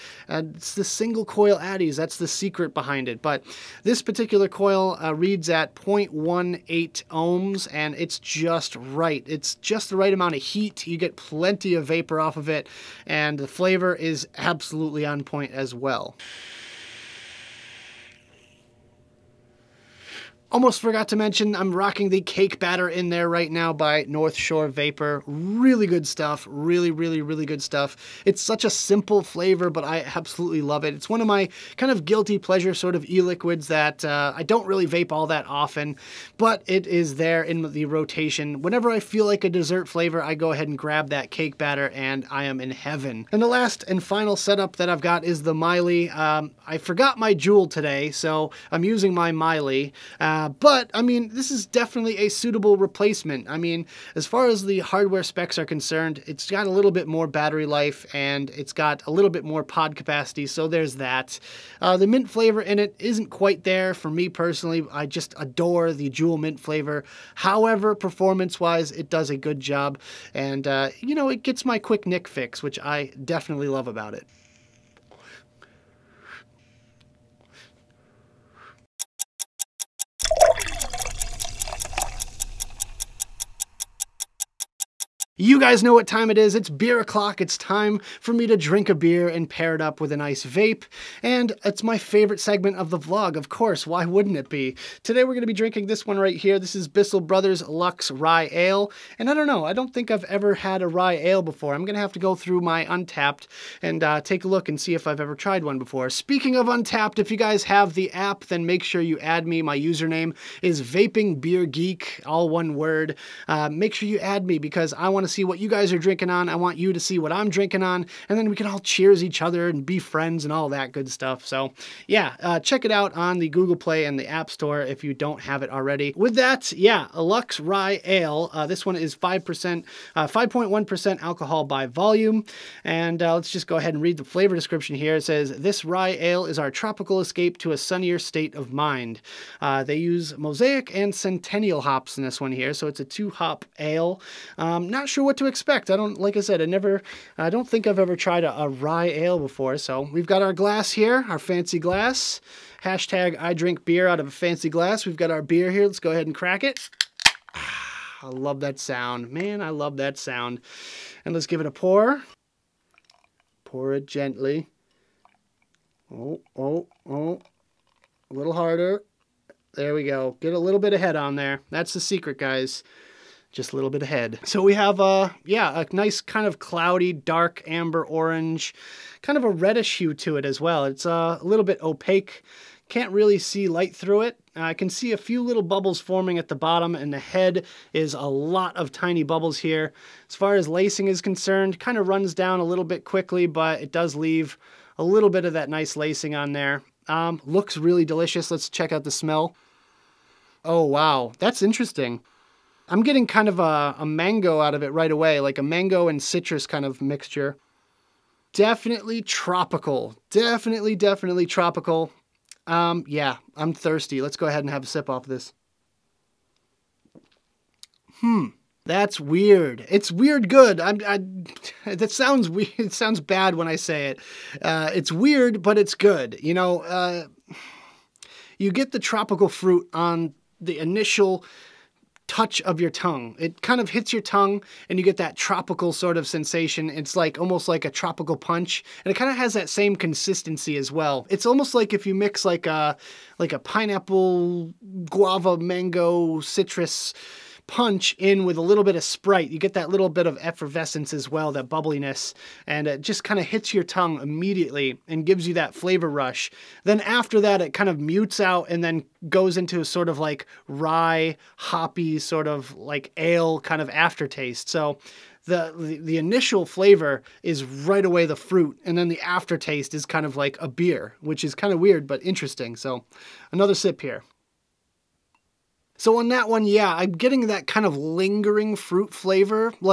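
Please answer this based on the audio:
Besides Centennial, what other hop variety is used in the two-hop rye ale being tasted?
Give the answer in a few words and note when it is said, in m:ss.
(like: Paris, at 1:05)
Mosaic, at 2:20.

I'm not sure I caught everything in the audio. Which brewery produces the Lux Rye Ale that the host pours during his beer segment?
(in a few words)
Bissell Brothers.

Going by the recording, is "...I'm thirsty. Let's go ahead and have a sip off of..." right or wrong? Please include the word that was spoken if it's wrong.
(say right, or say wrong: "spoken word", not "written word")
right.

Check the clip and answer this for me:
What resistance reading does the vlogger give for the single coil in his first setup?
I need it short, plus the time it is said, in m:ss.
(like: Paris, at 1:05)
0.18 ohms, at 0:05.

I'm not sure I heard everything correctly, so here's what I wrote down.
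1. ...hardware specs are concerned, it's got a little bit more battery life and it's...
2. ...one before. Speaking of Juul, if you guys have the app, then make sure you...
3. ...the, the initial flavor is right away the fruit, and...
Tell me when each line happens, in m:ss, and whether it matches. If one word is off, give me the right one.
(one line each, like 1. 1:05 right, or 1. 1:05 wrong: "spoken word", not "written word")
1. 0:54 right
2. 1:45 wrong: "Untappd", not "Juul"
3. 4:25 right.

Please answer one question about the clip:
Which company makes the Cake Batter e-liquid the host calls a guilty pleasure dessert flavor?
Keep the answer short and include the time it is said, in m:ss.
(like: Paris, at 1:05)
North Shore Vapor, at 0:24.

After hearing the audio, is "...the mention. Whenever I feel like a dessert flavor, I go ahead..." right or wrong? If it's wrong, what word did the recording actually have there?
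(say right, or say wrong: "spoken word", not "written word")
wrong: "rotation", not "mention".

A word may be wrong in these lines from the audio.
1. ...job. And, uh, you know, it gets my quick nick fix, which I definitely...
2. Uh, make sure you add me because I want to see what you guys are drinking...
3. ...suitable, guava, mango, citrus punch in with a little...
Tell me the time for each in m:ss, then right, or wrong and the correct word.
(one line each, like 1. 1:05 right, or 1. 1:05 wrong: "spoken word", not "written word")
1. 1:09 right
2. 1:53 right
3. 4:03 wrong: "pineapple", not "suitable".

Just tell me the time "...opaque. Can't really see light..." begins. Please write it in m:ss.
3:01.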